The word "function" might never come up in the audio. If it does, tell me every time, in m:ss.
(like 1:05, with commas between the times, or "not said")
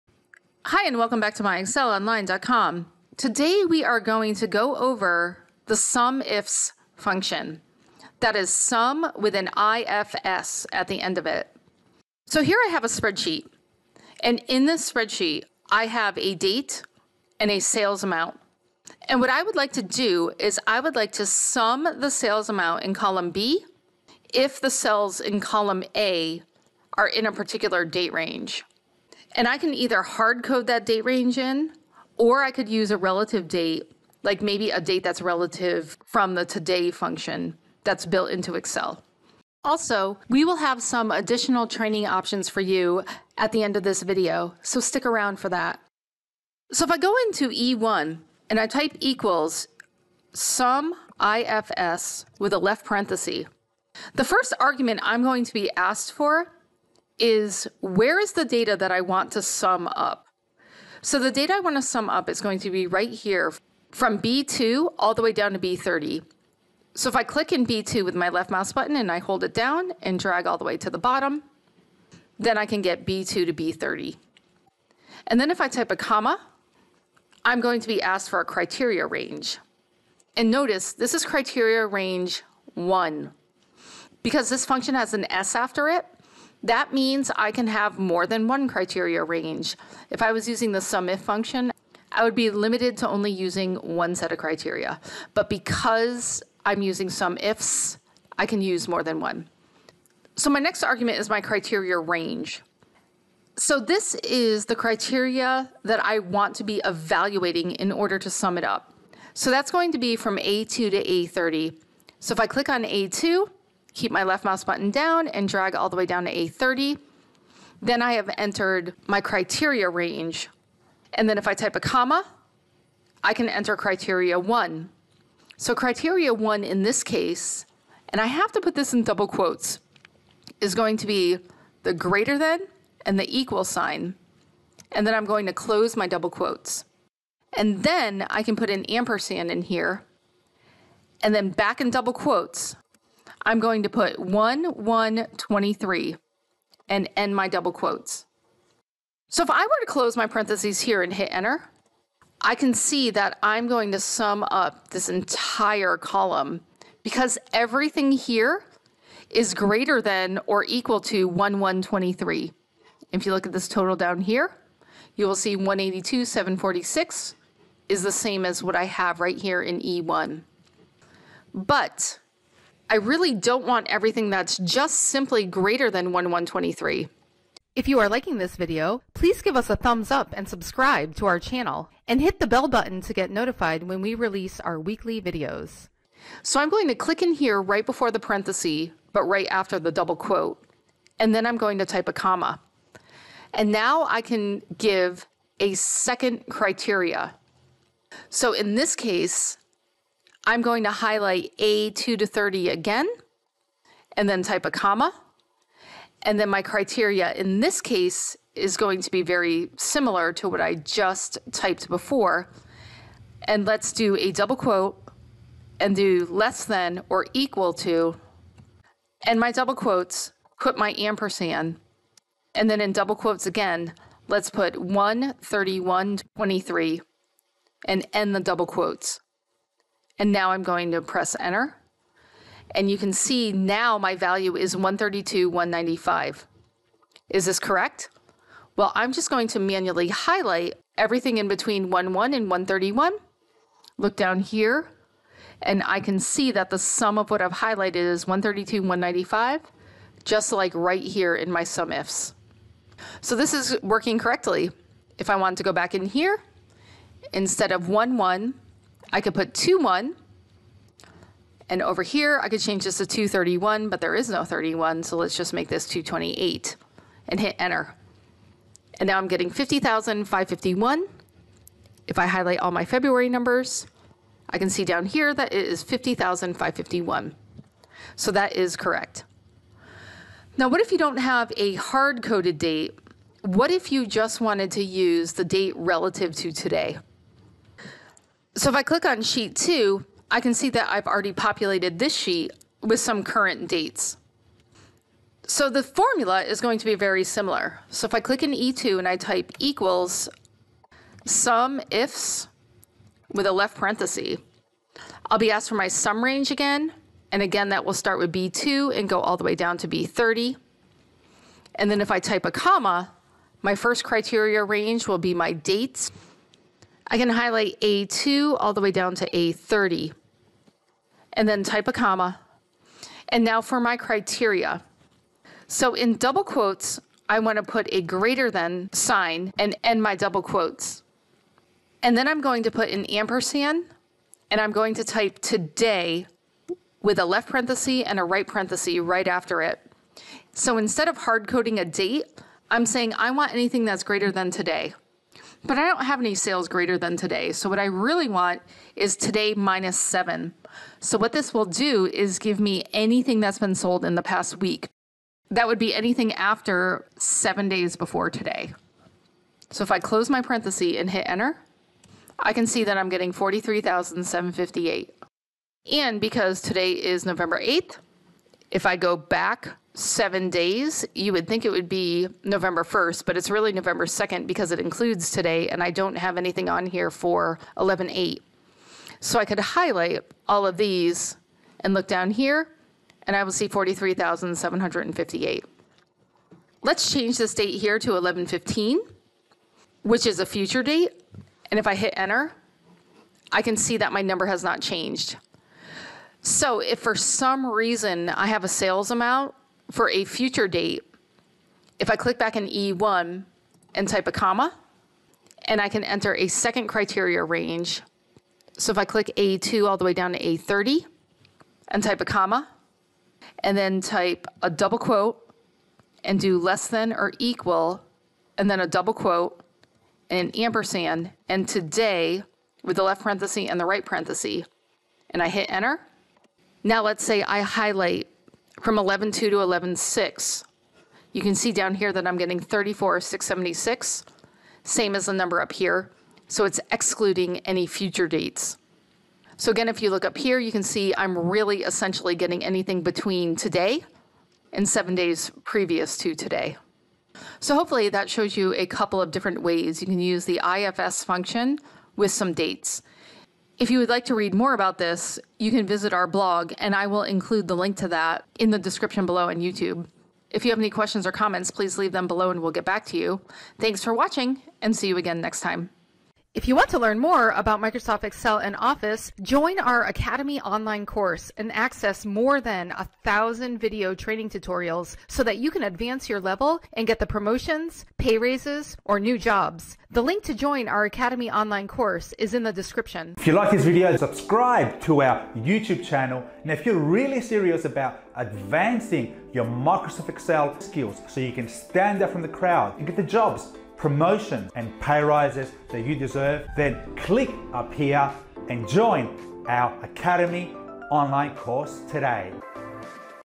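0:06, 0:36, 1:24, 1:31, 7:31.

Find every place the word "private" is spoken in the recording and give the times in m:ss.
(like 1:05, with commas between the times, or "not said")
not said.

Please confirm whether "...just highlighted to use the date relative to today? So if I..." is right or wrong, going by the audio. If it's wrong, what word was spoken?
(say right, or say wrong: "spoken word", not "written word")
wrong: "wanted", not "highlighted".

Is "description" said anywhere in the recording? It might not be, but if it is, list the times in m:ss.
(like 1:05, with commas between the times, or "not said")
7:38, 8:02.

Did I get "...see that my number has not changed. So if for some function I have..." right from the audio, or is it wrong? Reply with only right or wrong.
wrong.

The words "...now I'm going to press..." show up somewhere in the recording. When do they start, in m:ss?
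3:50.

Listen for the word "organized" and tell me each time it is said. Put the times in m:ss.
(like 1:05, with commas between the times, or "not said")
not said.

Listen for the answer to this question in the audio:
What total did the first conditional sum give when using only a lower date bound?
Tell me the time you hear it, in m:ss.
2:45.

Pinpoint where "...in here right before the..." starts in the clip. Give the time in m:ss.
3:07.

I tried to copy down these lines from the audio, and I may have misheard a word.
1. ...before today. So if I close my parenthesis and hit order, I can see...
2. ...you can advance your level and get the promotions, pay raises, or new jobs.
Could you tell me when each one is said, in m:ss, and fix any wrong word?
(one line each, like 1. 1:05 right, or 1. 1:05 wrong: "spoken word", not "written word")
1. 5:57 wrong: "enter", not "order"
2. 7:55 right.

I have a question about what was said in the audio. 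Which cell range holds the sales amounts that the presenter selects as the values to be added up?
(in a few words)
B2 to B30.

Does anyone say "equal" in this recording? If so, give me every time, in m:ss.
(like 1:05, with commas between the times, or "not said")
0:48, 2:13, 2:40, 3:37, 4:59, 6:57.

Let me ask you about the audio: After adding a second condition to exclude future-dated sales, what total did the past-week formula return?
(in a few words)
34,676.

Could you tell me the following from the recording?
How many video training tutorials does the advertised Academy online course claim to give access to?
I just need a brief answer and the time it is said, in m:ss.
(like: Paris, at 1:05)
more than 1,000, at 7:52.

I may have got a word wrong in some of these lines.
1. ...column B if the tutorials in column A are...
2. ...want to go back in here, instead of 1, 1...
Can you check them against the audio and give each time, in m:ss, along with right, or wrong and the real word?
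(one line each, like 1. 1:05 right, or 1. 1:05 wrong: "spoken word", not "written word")
1. 0:22 wrong: "cells", not "tutorials"
2. 4:15 right.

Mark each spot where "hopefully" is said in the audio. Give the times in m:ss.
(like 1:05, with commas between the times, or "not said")
7:27.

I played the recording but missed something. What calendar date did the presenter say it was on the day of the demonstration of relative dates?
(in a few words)
November 8th.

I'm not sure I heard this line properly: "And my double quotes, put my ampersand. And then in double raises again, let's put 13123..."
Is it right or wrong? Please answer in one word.
wrong.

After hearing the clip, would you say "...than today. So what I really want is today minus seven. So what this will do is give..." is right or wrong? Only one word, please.
right.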